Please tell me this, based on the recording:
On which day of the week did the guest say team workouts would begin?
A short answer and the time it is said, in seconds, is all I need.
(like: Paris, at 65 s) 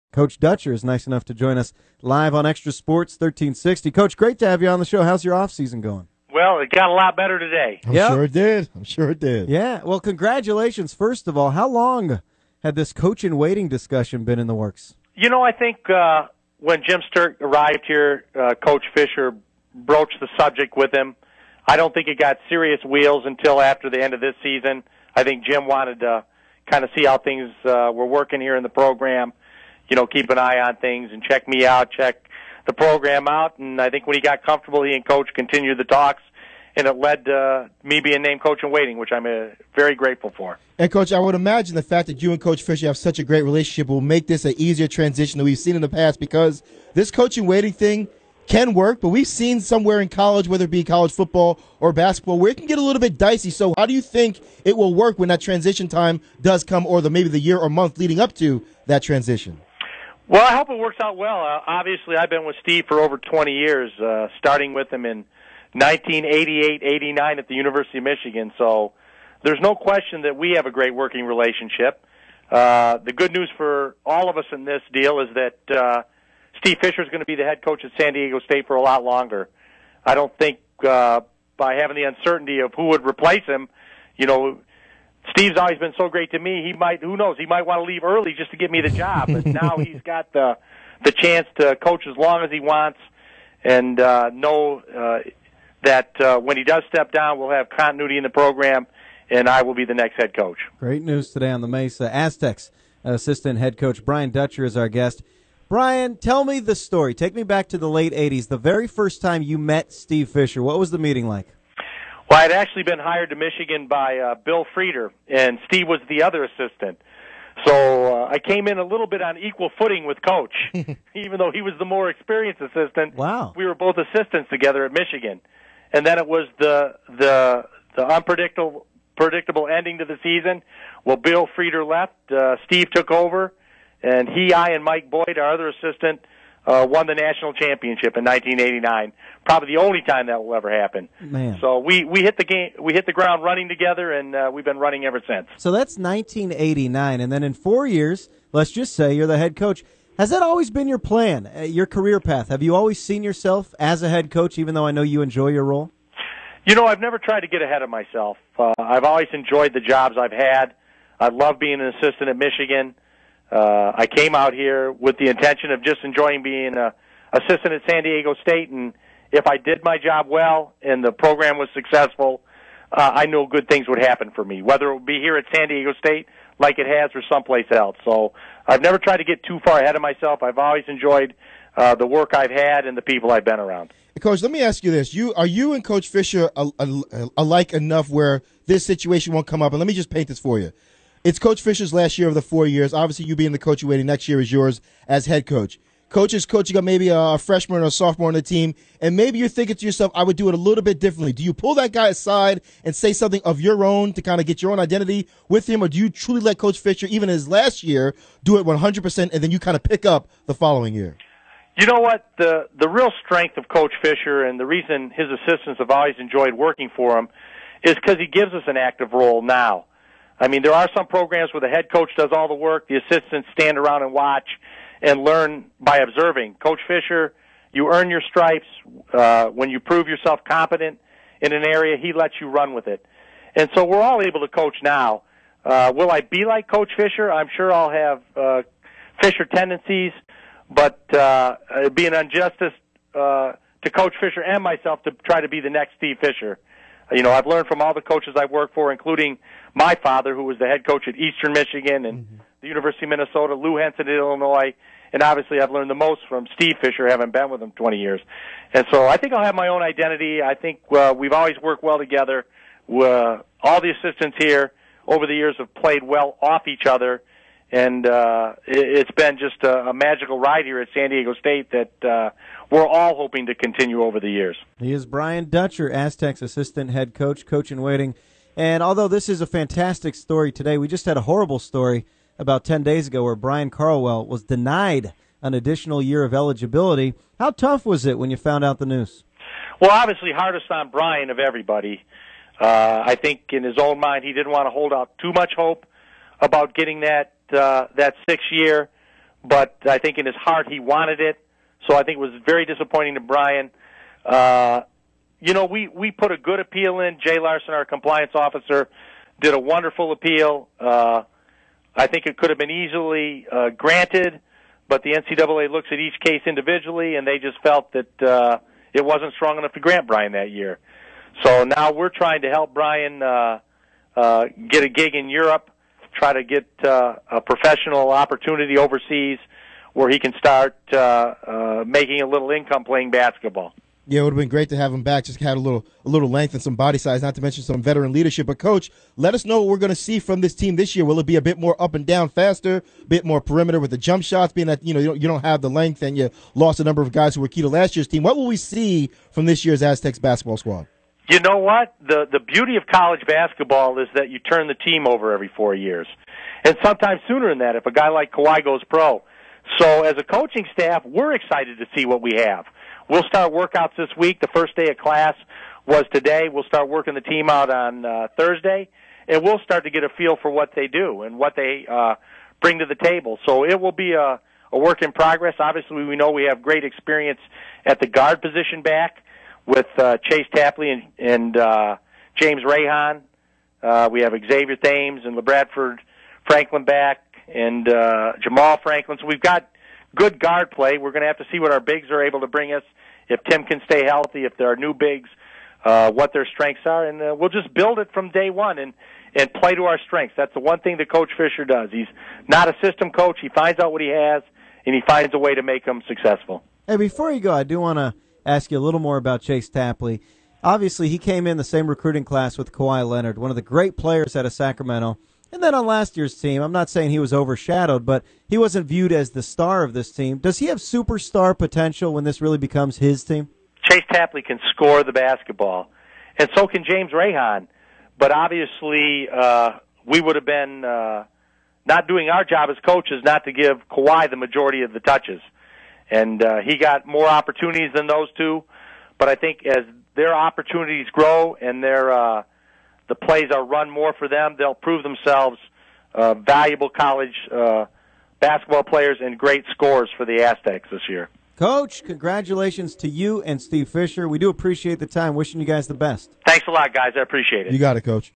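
Thursday, at 368 s.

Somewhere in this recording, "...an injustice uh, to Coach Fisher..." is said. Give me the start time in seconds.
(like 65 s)
242 s.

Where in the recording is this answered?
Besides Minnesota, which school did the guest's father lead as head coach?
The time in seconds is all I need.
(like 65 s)
251 s.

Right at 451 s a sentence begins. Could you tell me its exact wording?
Coach, congratulations to you and Steve Fisher.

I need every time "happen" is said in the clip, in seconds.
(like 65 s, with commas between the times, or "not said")
140 s, 173 s.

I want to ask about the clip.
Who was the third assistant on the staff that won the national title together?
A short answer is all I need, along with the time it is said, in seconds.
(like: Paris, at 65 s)
Mike Boyd, at 134 s.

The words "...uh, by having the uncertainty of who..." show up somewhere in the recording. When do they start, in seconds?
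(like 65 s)
80 s.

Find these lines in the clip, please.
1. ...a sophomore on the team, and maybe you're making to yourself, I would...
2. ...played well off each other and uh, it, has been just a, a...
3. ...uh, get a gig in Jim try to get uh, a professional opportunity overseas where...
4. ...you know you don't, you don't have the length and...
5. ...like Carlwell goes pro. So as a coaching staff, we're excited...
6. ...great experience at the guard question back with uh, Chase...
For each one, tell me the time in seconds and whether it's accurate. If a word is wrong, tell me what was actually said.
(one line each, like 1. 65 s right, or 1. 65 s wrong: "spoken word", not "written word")
1. 197 s wrong: "thinking", not "making"
2. 265 s right
3. 324 s wrong: "Europe", not "Jim"
4. 344 s right
5. 358 s wrong: "Kawhi", not "Carlwell"
6. 376 s wrong: "position", not "question".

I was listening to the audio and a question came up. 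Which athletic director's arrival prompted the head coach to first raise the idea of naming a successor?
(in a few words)
Jim Sterk.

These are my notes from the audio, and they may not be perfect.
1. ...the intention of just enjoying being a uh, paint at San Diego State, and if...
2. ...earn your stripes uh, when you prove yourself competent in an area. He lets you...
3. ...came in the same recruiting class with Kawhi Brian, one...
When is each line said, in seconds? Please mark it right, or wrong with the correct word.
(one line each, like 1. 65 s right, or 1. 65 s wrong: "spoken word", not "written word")
1. 165 s wrong: "assistant", not "paint"
2. 227 s right
3. 411 s wrong: "Leonard", not "Brian".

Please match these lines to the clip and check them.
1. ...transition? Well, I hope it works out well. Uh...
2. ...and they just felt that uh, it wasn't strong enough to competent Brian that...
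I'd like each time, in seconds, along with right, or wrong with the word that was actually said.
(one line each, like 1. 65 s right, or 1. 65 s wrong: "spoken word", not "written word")
1. 59 s right
2. 317 s wrong: "grant", not "competent".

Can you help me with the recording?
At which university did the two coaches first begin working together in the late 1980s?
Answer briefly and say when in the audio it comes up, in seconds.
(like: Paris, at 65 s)
University of Michigan, at 67 s.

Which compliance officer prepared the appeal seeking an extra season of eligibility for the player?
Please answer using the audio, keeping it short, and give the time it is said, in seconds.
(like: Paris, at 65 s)
Jay Larson, at 307 s.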